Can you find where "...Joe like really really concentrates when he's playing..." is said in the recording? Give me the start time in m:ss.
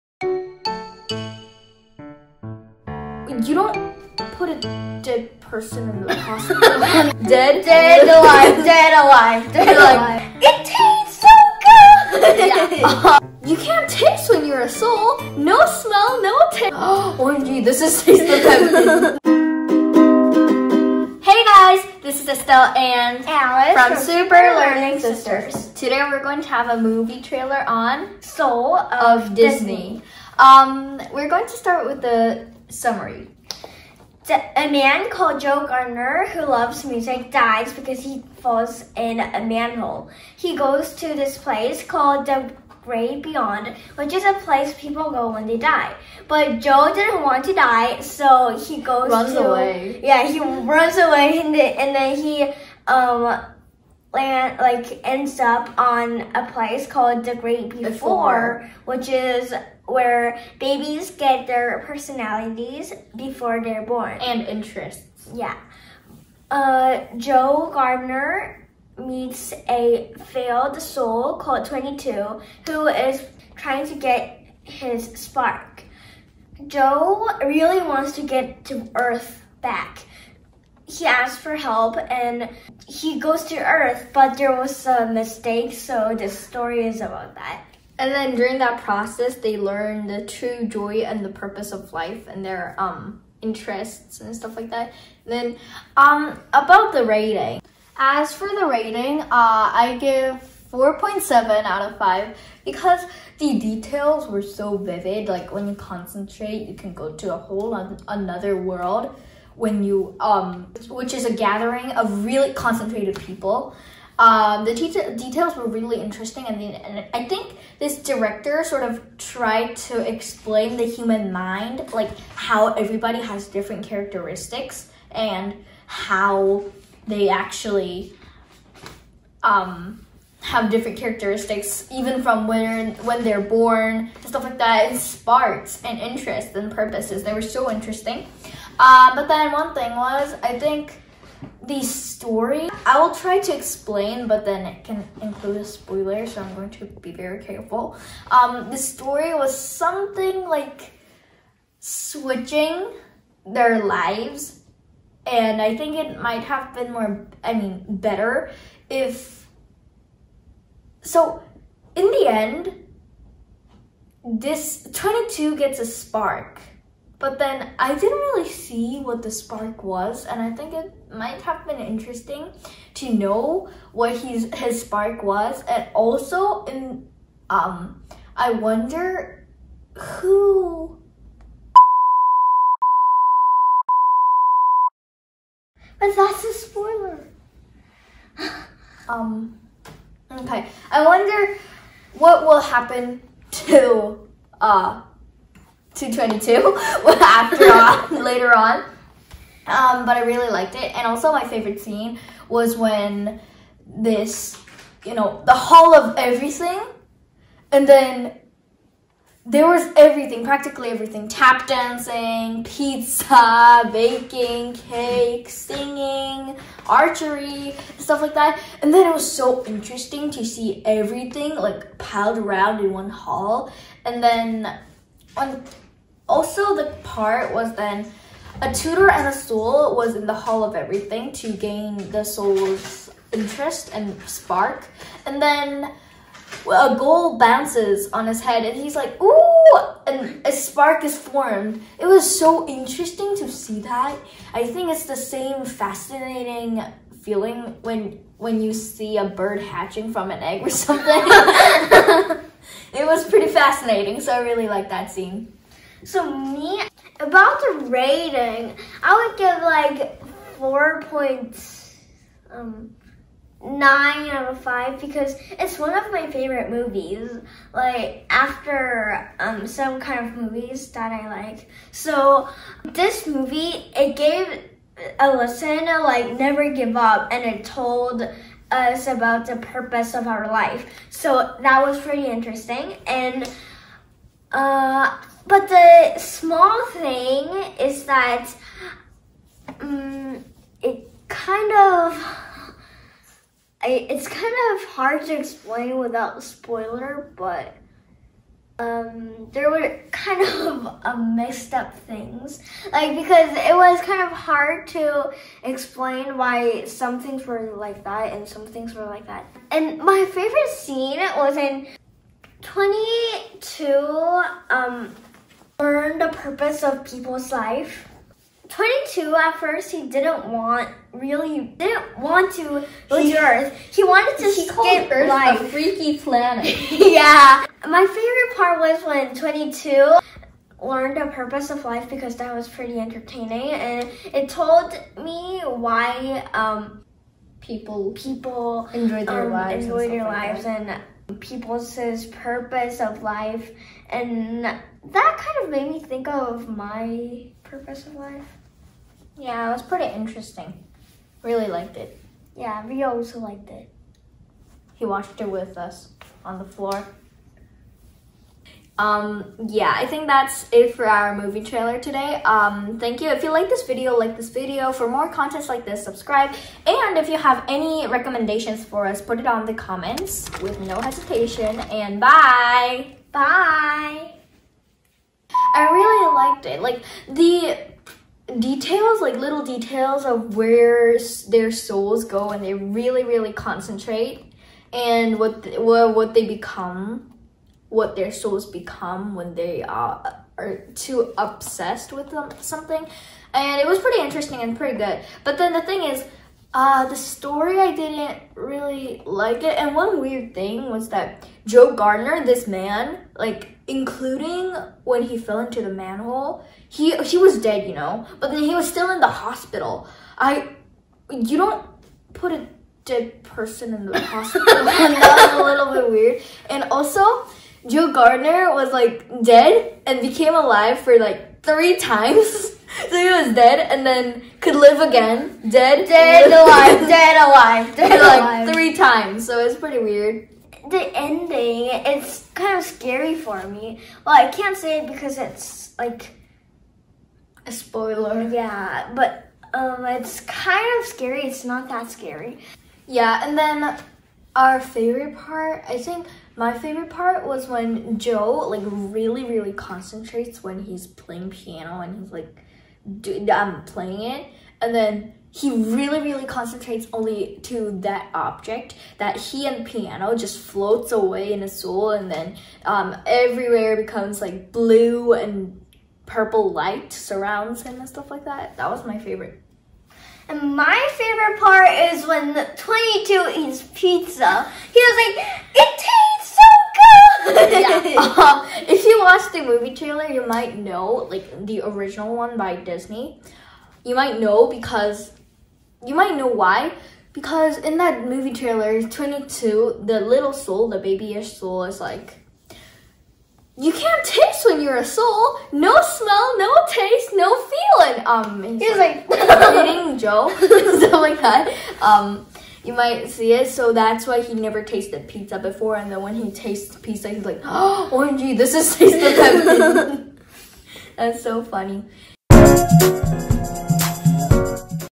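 7:28.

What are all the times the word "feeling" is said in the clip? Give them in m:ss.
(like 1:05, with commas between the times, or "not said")
4:07, 8:17.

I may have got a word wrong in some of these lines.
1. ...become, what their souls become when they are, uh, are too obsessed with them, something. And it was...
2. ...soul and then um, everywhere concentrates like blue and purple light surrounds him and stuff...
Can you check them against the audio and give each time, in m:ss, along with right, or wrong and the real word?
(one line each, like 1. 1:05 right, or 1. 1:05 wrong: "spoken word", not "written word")
1. 6:26 right
2. 7:41 wrong: "becomes", not "concentrates".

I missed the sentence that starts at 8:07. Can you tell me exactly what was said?
Because in that movie trailer, 22, the little soul, the babyish soul is like, you can't taste when you're a soul.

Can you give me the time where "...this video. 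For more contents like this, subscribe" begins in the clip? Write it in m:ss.
6:04.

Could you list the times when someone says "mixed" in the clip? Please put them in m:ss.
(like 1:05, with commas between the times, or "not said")
5:01.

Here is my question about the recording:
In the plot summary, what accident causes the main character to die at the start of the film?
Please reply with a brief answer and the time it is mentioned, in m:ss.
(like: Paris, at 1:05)
falls in a manhole, at 0:38.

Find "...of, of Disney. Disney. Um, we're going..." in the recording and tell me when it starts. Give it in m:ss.
0:28.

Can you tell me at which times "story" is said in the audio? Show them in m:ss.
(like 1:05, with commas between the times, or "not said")
1:26, 2:21, 2:28, 6:37.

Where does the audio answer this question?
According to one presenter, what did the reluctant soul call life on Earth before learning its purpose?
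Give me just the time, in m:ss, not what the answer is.
5:25.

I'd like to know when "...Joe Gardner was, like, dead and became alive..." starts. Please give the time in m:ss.
6:57.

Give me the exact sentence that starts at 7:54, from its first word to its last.
He was like, it tastes so good!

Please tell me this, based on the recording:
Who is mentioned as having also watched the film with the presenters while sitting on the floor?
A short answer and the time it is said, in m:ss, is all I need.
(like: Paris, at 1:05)
Rio, at 5:52.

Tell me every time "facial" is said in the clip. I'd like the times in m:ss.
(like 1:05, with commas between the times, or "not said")
not said.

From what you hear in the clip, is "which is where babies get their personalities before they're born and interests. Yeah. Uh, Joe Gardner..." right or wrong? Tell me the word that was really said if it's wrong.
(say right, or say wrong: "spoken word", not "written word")
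right.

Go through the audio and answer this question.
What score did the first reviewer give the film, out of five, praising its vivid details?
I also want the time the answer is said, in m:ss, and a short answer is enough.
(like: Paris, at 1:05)
4.7, at 1:40.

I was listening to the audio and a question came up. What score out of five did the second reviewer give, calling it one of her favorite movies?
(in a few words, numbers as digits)
4.9.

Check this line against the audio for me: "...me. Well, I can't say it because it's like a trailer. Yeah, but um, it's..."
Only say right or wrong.
wrong.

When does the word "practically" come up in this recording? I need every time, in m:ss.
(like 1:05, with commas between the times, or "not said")
3:30.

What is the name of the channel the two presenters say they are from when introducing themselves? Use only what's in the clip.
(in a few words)
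Super Learning Sisters.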